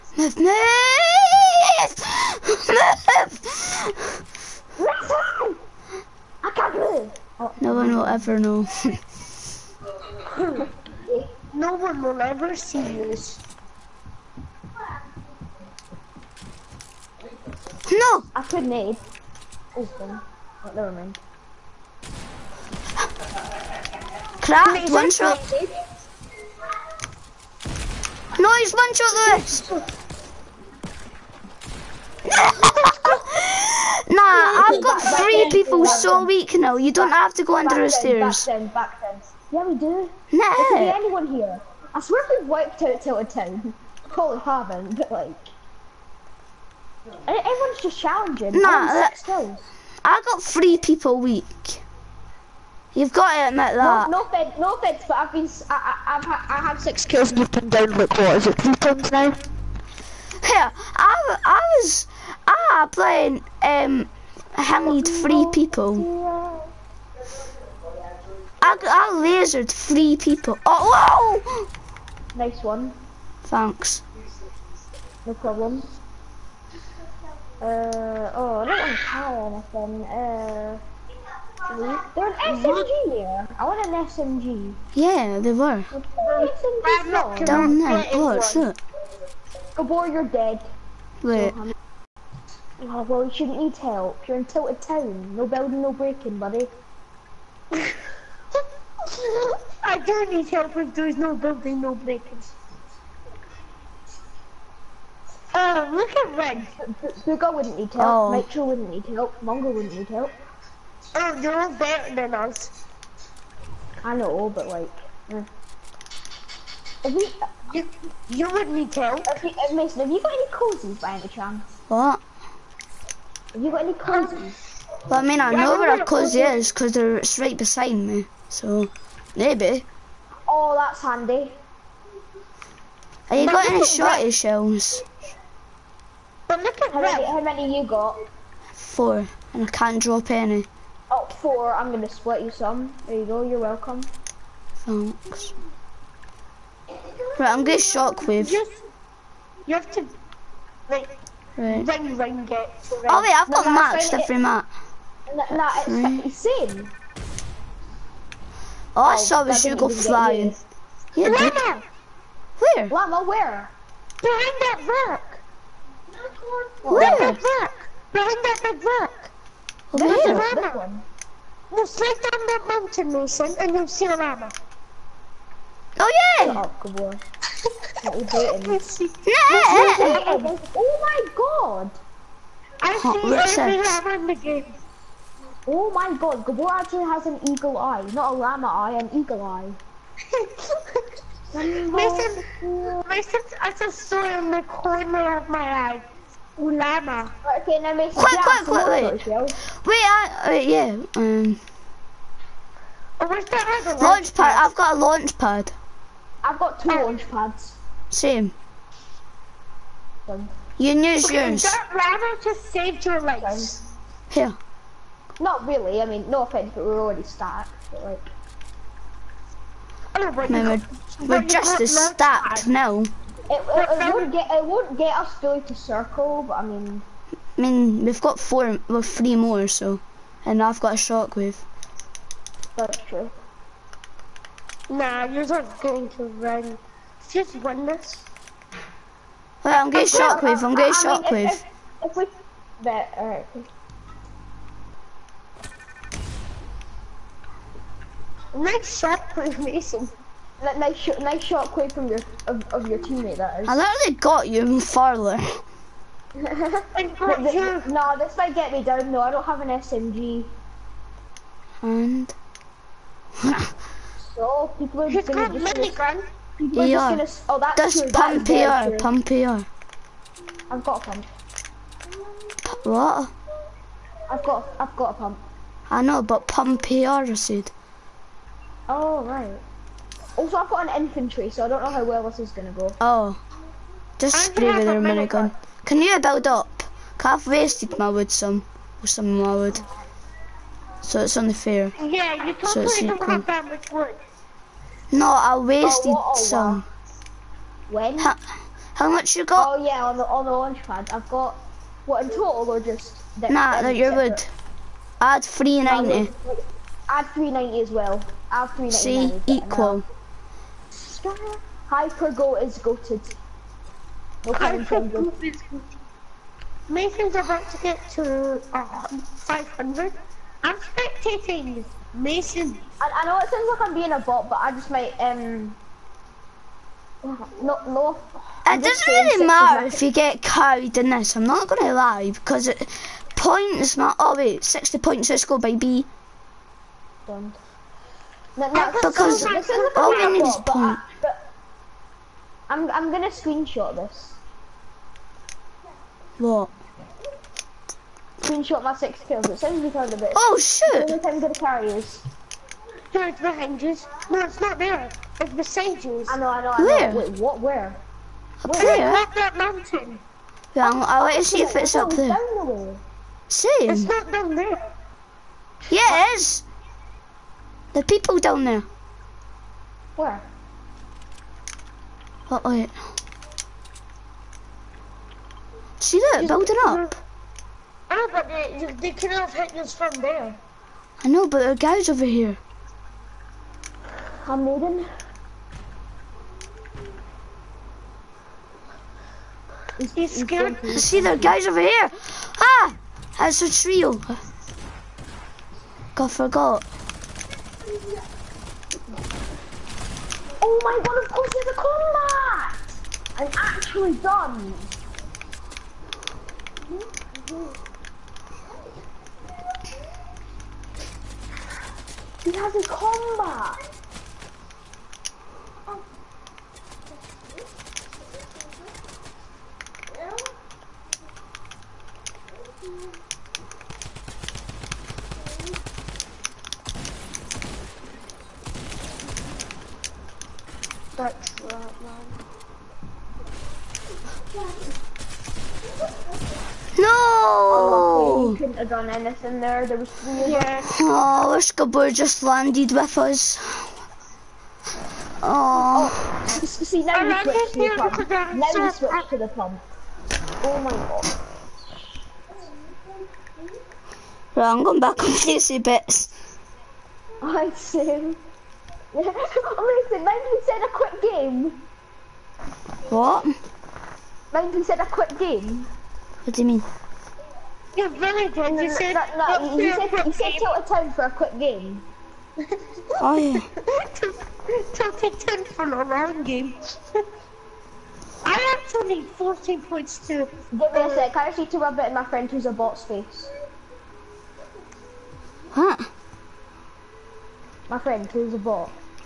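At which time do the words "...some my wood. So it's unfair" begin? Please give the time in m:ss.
4:49.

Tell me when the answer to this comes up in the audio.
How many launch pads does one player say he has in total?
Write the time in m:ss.
3:26.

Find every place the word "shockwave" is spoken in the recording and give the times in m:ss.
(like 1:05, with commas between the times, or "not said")
2:27, 3:50.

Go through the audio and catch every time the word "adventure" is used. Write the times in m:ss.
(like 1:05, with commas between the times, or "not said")
not said.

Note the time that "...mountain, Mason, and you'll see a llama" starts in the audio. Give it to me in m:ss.
2:52.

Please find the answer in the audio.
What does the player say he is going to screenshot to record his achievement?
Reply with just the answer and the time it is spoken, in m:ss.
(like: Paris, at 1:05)
six kills, at 5:48.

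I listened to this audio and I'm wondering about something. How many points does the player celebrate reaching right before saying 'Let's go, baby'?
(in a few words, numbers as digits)
60.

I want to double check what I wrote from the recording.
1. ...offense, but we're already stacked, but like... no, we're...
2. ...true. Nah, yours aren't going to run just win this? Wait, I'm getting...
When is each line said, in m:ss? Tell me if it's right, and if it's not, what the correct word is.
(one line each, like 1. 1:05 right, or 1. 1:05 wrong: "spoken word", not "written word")
1. 3:36 right
2. 3:53 right.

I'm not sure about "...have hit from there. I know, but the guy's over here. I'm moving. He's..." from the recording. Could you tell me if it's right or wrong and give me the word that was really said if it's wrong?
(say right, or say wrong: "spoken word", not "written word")
right.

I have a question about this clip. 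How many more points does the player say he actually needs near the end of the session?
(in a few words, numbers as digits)
14.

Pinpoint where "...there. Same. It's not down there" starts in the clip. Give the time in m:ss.
6:02.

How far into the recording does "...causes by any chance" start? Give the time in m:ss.
2:00.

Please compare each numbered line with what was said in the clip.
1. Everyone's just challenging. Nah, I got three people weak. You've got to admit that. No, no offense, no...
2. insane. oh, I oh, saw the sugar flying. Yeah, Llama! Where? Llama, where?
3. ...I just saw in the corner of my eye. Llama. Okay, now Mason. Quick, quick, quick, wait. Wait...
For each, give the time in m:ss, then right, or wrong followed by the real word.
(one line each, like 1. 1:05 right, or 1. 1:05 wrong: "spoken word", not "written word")
1. 0:47 right
2. 2:36 right
3. 3:13 right.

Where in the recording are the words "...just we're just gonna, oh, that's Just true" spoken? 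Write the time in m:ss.
4:25.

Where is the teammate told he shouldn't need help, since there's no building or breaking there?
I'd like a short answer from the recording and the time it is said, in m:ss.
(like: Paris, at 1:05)
Tilted Town, at 1:34.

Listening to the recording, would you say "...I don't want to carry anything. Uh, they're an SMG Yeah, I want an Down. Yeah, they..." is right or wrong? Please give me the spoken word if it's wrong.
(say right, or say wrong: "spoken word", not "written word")
wrong: "SMG", not "Down".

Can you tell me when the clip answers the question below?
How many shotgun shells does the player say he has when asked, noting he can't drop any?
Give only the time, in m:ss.
2:18.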